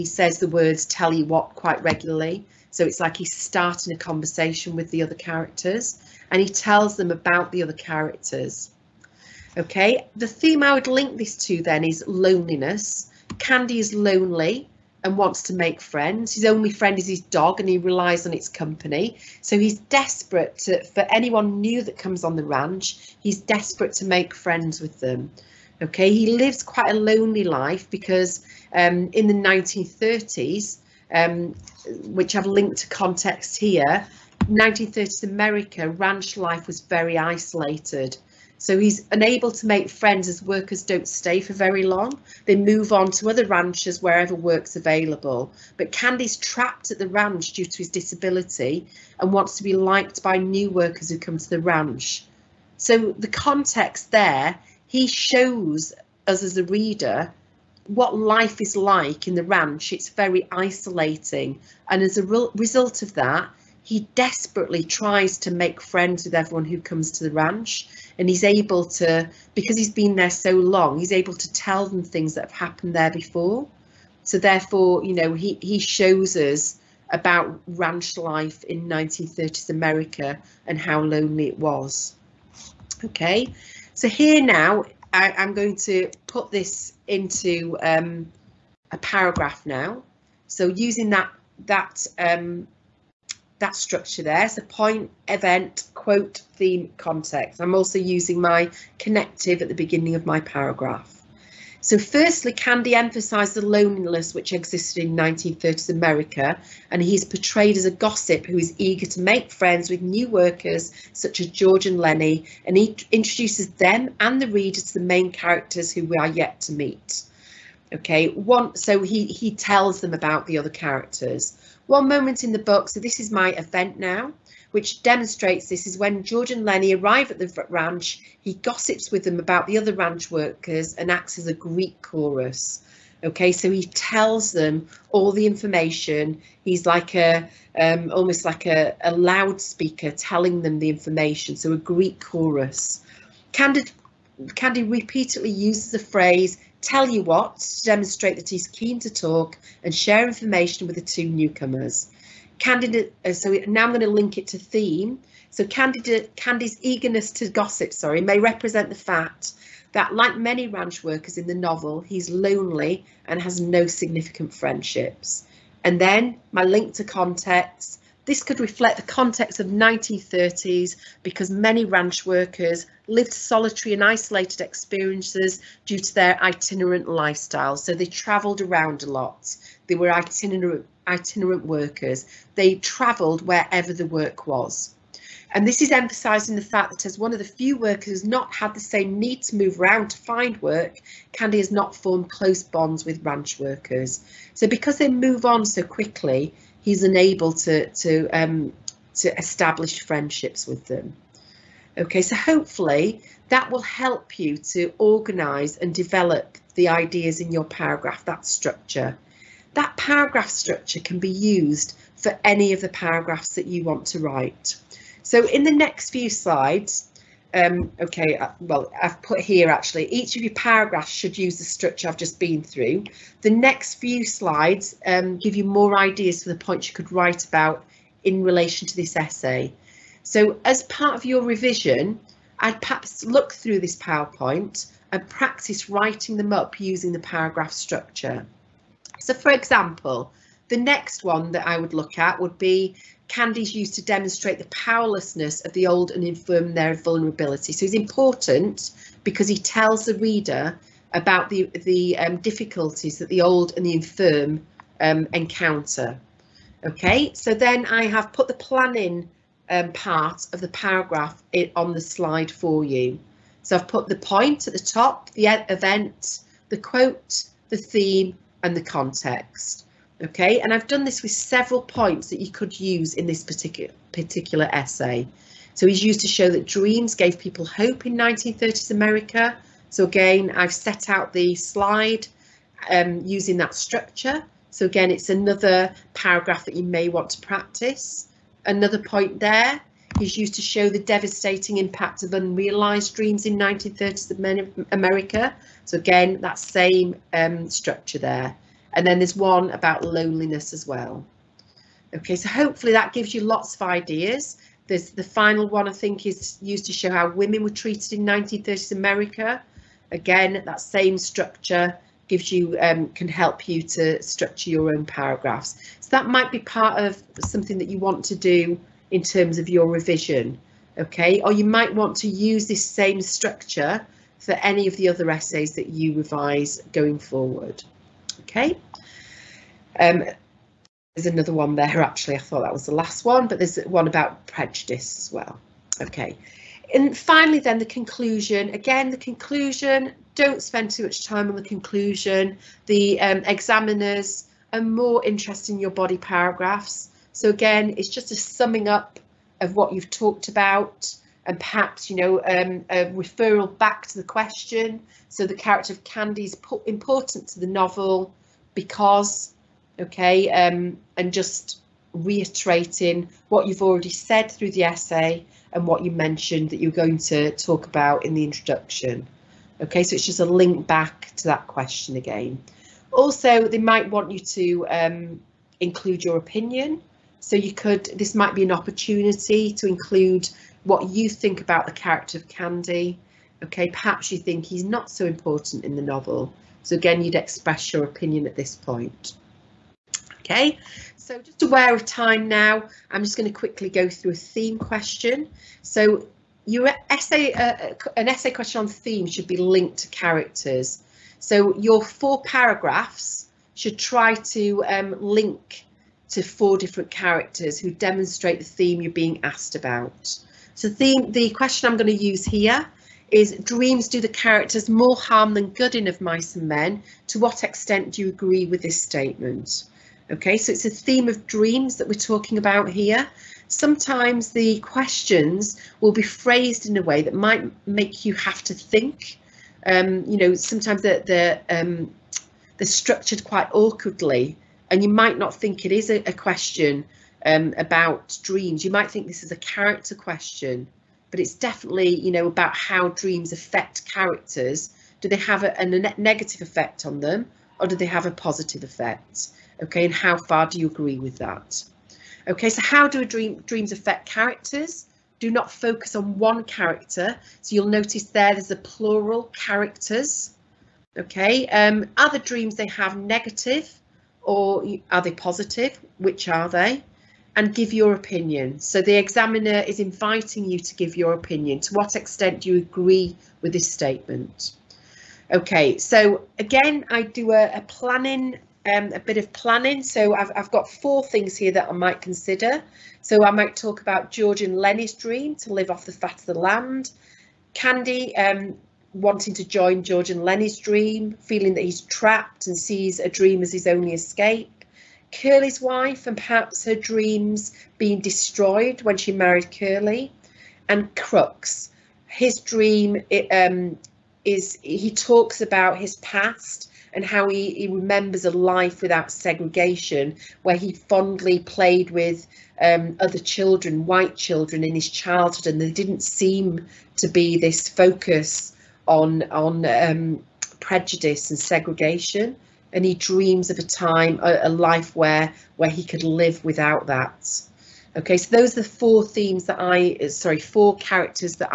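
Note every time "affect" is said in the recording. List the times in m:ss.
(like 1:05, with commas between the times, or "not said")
7:23, 7:33.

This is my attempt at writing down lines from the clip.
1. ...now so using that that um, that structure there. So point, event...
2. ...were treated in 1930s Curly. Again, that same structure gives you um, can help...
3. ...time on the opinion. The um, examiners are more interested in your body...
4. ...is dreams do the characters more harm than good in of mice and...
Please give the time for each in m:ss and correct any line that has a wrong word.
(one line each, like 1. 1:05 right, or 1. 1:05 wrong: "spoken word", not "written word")
1. 1:29 right
2. 5:07 wrong: "America", not "Curly"
3. 5:41 wrong: "conclusion", not "opinion"
4. 6:53 right.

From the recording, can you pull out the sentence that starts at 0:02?
So it's like he's starting a conversation with the other characters and he tells them about the other characters.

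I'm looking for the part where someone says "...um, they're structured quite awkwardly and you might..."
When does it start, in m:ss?
7:11.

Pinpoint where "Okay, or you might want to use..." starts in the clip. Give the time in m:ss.
5:20.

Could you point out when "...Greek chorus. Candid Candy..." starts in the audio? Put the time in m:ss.
2:21.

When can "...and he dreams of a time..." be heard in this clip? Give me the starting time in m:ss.
8:42.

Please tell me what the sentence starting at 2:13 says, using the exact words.
Okay, so he tells them all the information.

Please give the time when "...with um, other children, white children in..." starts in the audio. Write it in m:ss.
8:32.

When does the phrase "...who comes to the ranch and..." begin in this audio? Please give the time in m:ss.
1:06.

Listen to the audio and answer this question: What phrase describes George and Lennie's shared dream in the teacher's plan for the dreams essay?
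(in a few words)
live off the fat of the land.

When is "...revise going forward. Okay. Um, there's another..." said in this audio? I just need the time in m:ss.
5:26.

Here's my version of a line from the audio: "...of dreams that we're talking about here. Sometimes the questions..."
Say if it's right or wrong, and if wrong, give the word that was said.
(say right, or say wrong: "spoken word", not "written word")
right.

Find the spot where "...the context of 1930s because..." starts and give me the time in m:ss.
2:48.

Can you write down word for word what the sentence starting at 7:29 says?
Okay, and how far do you agree with that?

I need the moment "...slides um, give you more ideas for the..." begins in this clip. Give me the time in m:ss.
3:44.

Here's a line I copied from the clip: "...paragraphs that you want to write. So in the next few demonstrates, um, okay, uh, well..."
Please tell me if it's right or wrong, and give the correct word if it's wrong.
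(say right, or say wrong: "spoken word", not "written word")
wrong: "slides", not "demonstrates".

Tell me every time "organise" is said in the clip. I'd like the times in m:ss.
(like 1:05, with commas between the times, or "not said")
3:24.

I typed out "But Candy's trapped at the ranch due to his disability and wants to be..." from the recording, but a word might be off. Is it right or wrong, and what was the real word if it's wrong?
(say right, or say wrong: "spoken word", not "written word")
right.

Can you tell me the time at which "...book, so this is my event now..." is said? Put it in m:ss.
2:02.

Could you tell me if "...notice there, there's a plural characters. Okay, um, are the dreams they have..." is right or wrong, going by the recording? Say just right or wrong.
right.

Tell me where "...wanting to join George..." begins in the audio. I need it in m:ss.
8:09.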